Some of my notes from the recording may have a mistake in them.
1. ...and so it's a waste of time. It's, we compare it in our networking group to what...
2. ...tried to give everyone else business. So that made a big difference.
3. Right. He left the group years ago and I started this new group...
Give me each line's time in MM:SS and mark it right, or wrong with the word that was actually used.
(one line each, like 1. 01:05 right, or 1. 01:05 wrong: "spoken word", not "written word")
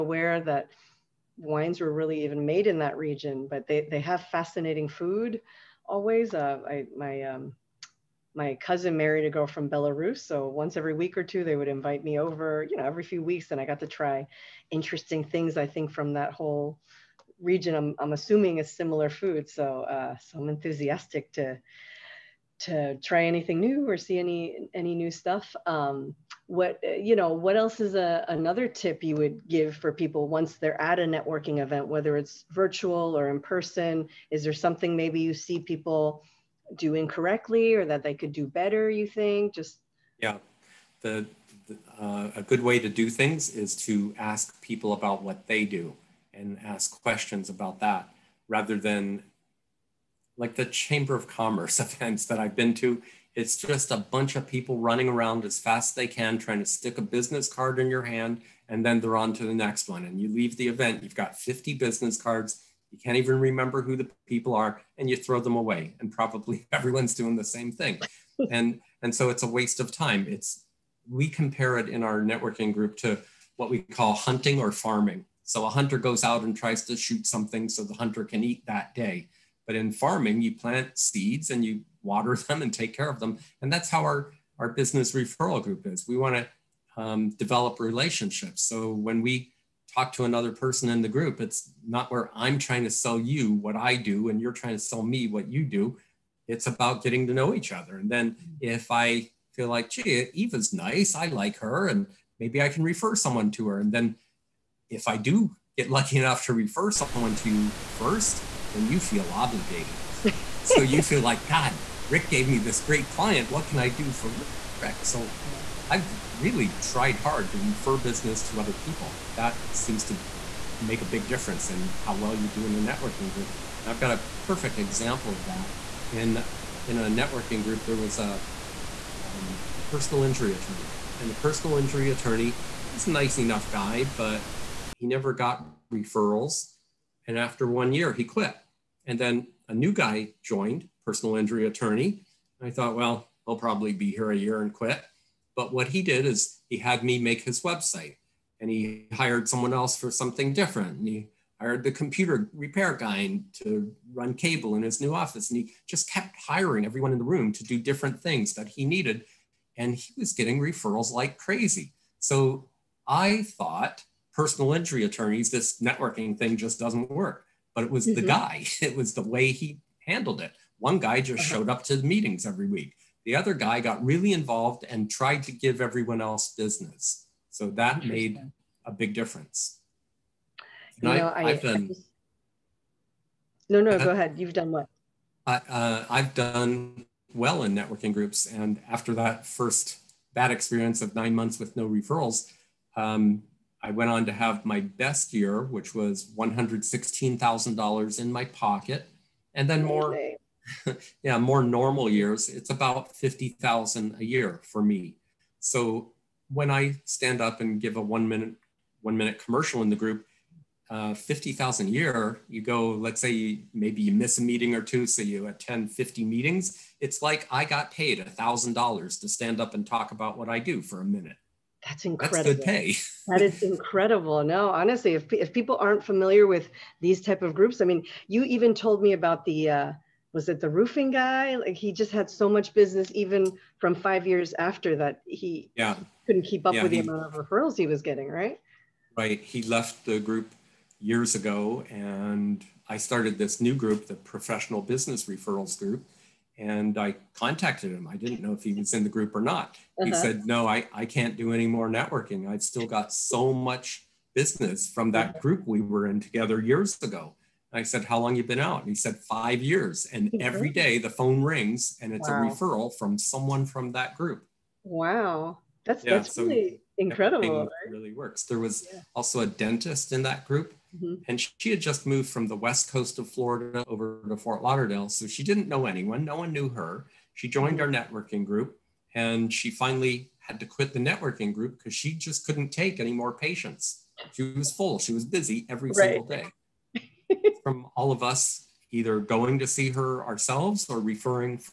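1. 01:09 right
2. 02:55 right
3. 03:59 right.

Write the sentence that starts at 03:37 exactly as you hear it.
It's like I got paid $1,000 to stand up and talk about what I do for a minute.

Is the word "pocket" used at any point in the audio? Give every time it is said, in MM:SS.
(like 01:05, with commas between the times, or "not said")
03:18.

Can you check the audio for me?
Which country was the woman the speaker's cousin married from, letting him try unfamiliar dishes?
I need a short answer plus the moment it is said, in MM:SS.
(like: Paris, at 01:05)
Belarus, at 00:09.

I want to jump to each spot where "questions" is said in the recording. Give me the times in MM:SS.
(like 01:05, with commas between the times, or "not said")
00:47.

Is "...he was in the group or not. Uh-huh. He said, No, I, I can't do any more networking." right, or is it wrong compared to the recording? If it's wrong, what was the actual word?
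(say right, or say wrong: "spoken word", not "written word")
right.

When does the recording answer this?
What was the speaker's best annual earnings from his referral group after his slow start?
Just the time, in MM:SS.
03:16.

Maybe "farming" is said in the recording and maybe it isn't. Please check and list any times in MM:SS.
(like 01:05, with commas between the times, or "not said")
01:14, 01:19.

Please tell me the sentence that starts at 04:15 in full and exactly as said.
group we were in together years ago.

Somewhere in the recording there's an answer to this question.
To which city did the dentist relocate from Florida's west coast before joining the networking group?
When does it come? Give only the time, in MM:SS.
04:34.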